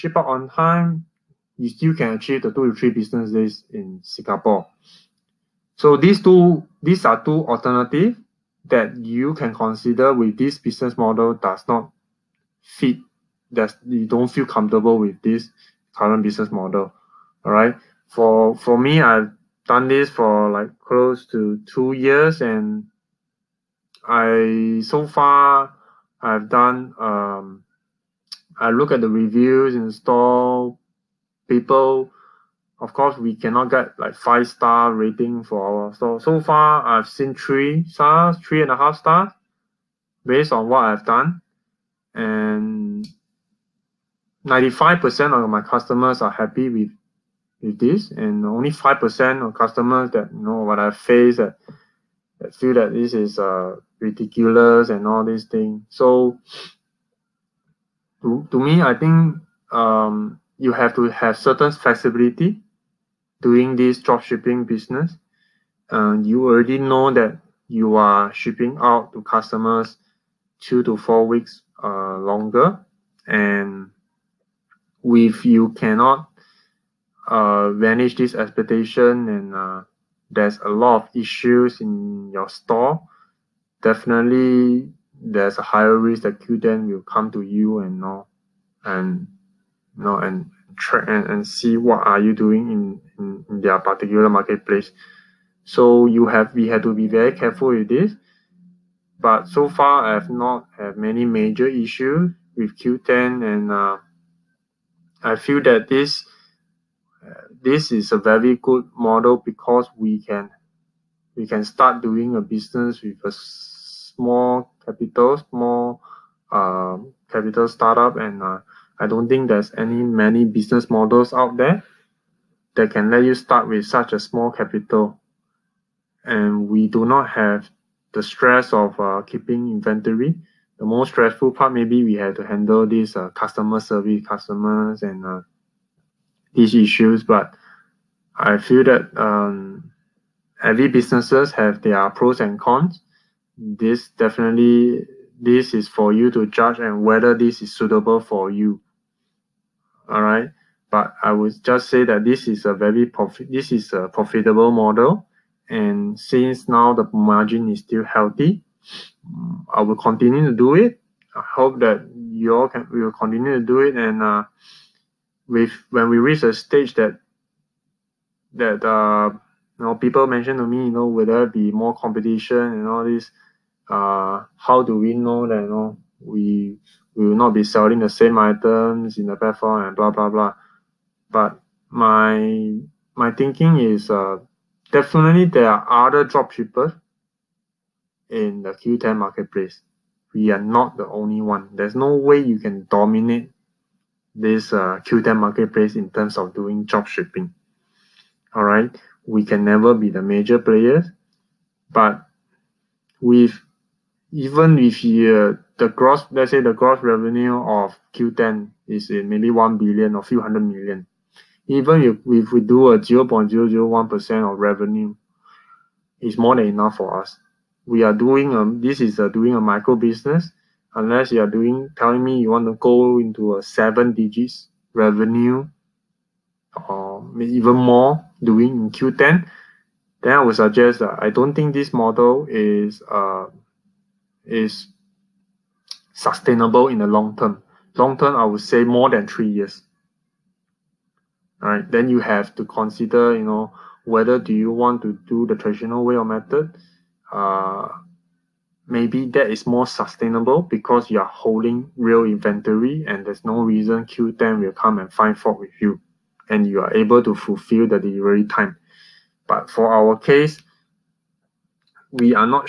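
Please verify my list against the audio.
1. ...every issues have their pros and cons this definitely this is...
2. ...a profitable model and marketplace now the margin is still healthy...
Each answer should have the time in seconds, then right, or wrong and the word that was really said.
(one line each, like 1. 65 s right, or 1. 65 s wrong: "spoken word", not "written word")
1. 140 s wrong: "businesses", not "issues"
2. 153 s wrong: "since", not "marketplace".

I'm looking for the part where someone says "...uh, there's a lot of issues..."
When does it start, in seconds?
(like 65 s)
79 s.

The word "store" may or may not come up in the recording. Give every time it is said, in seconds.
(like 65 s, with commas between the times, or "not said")
29 s, 35 s, 82 s.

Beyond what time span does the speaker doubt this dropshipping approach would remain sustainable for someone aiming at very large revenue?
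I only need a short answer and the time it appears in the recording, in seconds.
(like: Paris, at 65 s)
more than 3 years, at 238 s.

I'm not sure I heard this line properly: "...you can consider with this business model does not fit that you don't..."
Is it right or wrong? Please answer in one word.
right.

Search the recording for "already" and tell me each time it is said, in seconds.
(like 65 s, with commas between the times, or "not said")
66 s.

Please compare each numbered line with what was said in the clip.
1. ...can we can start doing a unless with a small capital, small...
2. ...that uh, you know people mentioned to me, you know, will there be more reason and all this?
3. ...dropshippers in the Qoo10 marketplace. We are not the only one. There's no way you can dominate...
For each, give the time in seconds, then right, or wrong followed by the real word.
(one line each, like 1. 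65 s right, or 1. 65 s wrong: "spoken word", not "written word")
1. 110 s wrong: "business", not "unless"
2. 168 s wrong: "competition", not "reason"
3. 186 s right.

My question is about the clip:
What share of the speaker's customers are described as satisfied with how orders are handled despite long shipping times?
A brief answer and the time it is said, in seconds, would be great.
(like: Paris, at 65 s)
95%, at 44 s.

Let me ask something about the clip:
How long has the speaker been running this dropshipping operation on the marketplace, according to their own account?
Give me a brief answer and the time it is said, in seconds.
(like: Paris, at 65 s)
close to 2 years, at 20 s.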